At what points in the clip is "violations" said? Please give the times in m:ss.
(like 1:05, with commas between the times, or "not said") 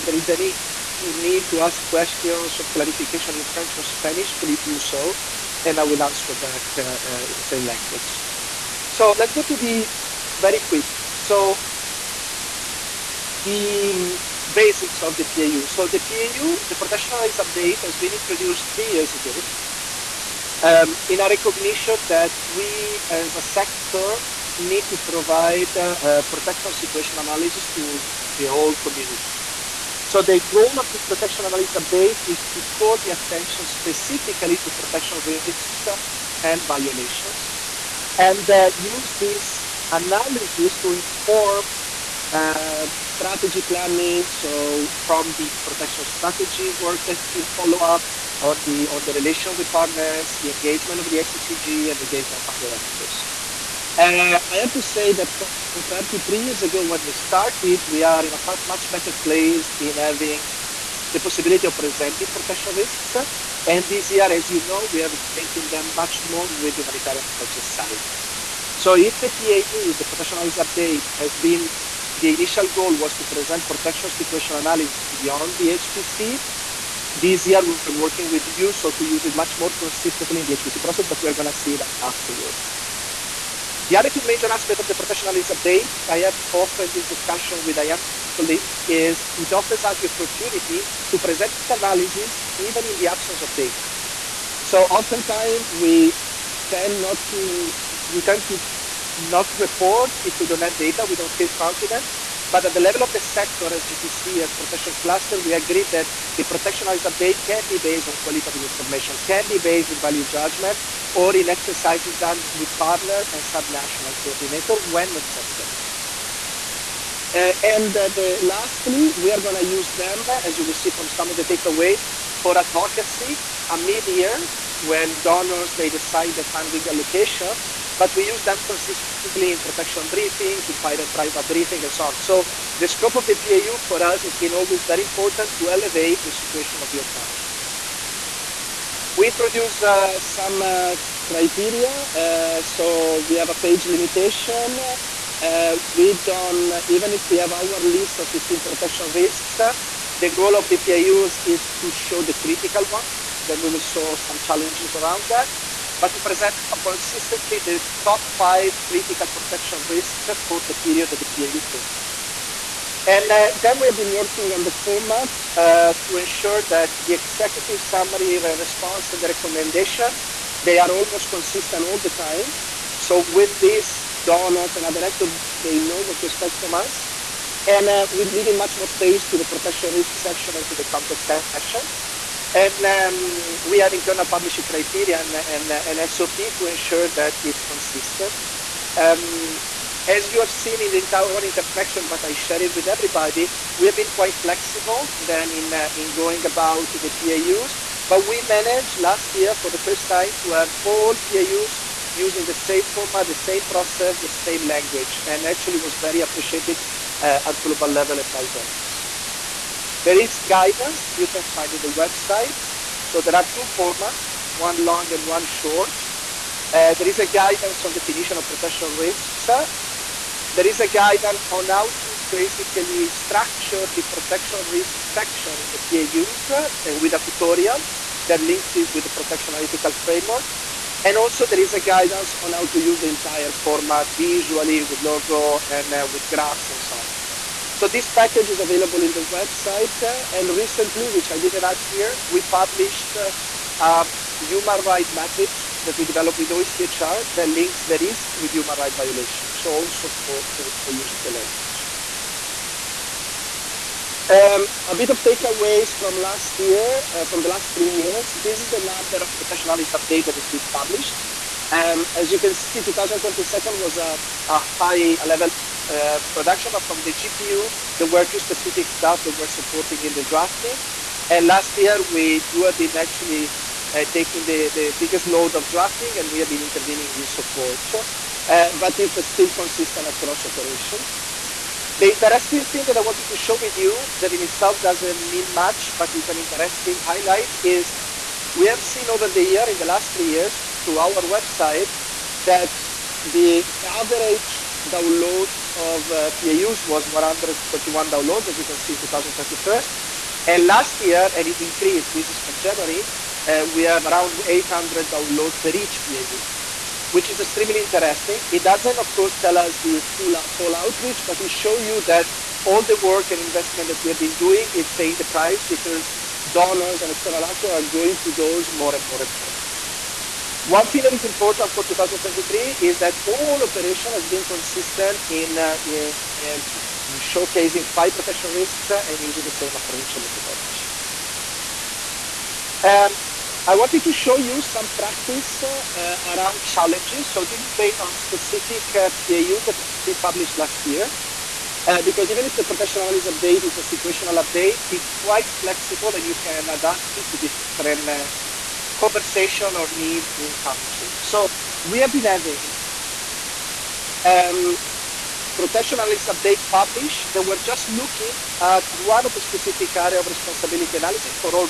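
0:36, 4:08.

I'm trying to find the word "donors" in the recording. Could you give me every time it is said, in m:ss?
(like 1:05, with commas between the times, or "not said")
2:05, 2:54, 3:28, 5:16.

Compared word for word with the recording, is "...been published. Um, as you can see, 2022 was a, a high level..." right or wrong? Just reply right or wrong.
right.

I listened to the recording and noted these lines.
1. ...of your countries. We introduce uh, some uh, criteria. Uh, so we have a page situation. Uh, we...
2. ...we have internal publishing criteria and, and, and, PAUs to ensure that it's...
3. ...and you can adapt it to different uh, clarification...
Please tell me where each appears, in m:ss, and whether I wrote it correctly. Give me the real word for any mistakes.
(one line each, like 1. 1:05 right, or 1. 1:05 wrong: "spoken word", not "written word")
1. 2:16 wrong: "limitation", not "situation"
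2. 3:03 wrong: "SOP", not "PAUs"
3. 5:46 wrong: "conversation", not "clarification".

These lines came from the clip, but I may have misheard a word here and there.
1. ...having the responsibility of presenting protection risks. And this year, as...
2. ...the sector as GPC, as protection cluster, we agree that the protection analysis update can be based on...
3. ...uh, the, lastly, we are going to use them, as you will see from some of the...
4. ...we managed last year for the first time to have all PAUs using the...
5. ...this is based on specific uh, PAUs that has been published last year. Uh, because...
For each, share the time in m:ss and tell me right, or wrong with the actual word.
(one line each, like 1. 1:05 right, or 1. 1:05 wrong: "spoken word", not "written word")
1. 0:59 wrong: "possibility", not "responsibility"
2. 1:43 right
3. 1:57 right
4. 3:18 right
5. 5:37 right.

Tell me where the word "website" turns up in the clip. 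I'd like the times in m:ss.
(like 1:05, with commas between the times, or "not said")
3:31, 3:59, 4:51.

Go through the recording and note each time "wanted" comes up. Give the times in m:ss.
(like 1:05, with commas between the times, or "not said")
4:43, 5:33.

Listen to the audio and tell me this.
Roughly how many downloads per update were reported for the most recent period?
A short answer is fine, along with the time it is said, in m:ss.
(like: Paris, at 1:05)
800, at 5:04.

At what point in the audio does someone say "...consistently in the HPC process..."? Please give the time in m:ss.
1:19.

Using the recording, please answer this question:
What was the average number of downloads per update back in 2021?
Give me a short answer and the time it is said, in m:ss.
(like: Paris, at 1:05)
131, at 4:57.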